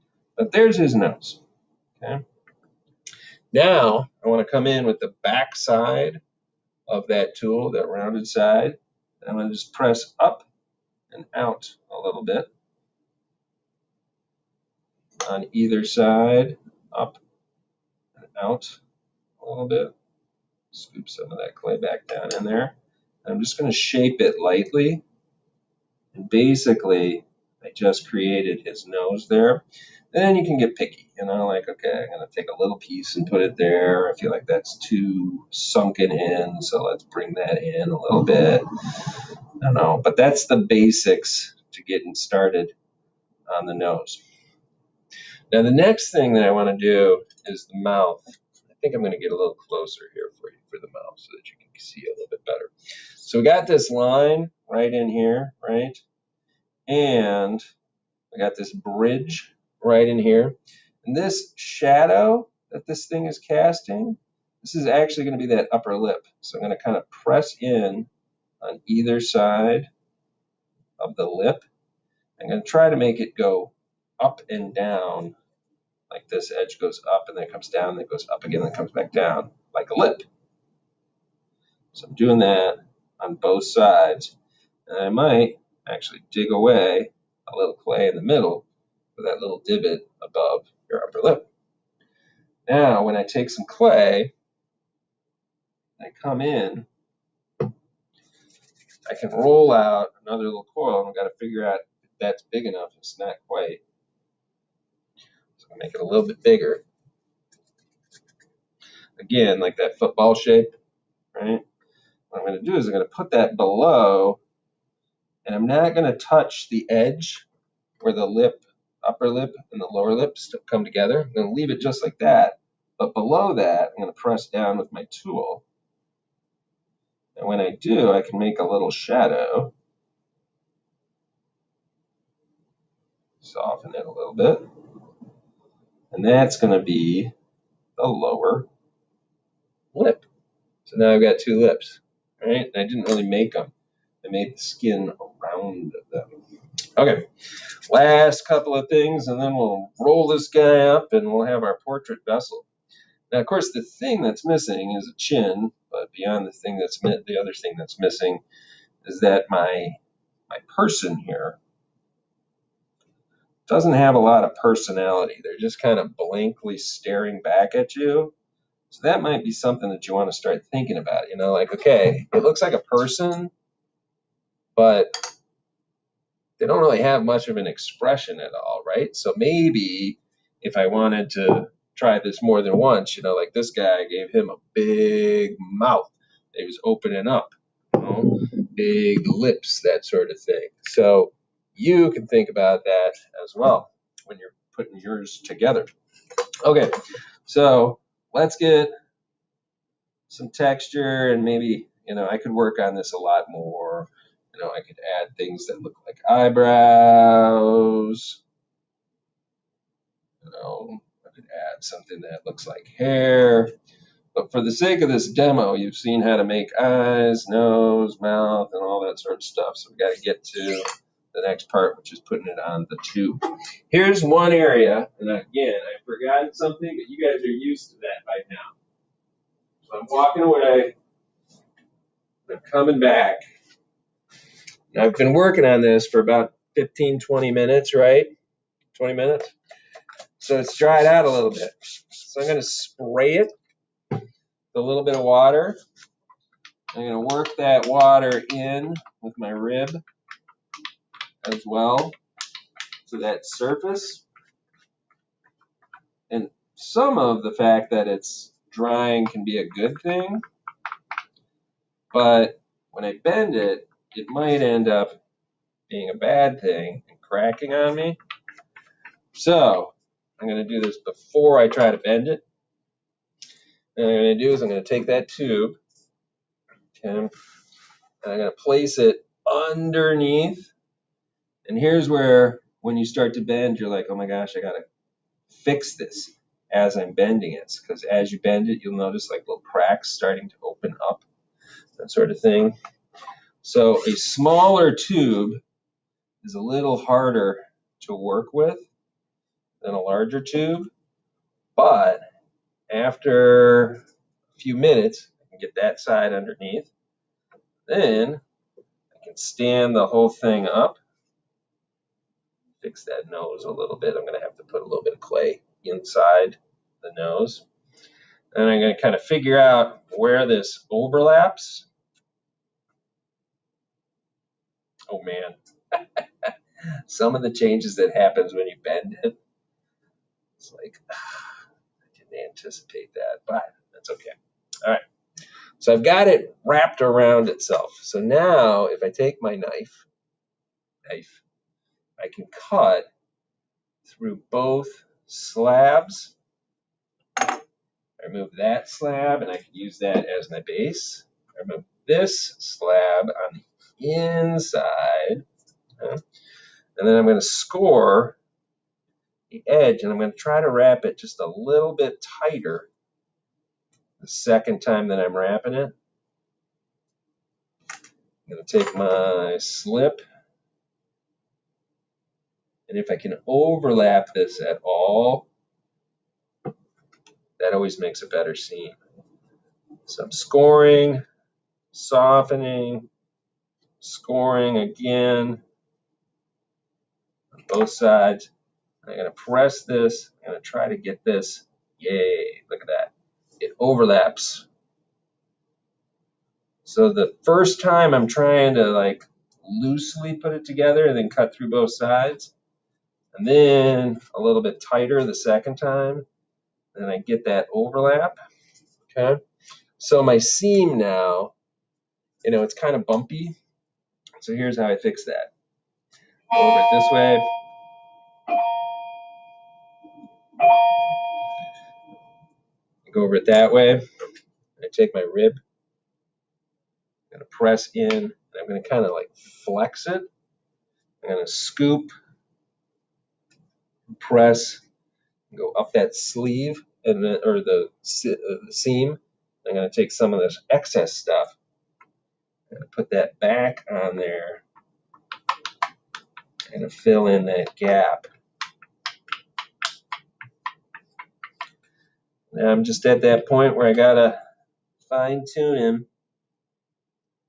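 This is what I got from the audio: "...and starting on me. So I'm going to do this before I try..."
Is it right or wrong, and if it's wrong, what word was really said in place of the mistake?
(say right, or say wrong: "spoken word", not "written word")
wrong: "cracking", not "starting".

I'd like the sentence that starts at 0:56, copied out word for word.
And we got this bridge right in here.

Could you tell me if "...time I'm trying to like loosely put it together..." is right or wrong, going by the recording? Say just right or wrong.
right.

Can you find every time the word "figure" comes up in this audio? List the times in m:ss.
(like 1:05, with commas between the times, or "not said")
1:41, 5:19.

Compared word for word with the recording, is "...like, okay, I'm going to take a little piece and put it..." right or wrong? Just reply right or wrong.
right.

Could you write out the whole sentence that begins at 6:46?
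Then I get that overlap, okay?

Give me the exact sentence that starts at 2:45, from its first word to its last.
They're just kind of blankly staring back at you.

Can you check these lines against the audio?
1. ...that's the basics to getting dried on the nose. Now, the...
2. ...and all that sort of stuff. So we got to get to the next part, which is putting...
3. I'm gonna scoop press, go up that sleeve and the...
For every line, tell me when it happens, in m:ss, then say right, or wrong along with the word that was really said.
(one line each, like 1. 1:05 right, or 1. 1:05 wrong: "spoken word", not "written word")
1. 0:40 wrong: "started", not "dried"
2. 3:38 right
3. 7:11 right.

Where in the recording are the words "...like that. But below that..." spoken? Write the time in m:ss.
2:02.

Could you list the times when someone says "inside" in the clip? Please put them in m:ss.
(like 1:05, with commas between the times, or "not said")
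5:15, 5:54.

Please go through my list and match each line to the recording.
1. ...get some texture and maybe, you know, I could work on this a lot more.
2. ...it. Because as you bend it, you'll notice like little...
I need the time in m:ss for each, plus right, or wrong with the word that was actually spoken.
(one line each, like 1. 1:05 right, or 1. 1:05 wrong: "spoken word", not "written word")
1. 3:18 right
2. 4:47 right.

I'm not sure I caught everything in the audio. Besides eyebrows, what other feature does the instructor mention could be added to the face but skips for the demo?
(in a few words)
Hair.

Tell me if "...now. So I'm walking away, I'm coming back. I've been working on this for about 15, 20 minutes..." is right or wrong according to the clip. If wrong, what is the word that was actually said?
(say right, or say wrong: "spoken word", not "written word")
right.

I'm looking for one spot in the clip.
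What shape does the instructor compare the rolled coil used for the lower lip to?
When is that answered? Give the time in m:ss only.
1:49.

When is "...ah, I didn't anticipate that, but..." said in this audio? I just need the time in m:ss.
5:31.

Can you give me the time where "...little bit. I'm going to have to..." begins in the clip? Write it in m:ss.
5:13.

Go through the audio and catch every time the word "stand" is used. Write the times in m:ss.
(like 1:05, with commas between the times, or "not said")
5:09.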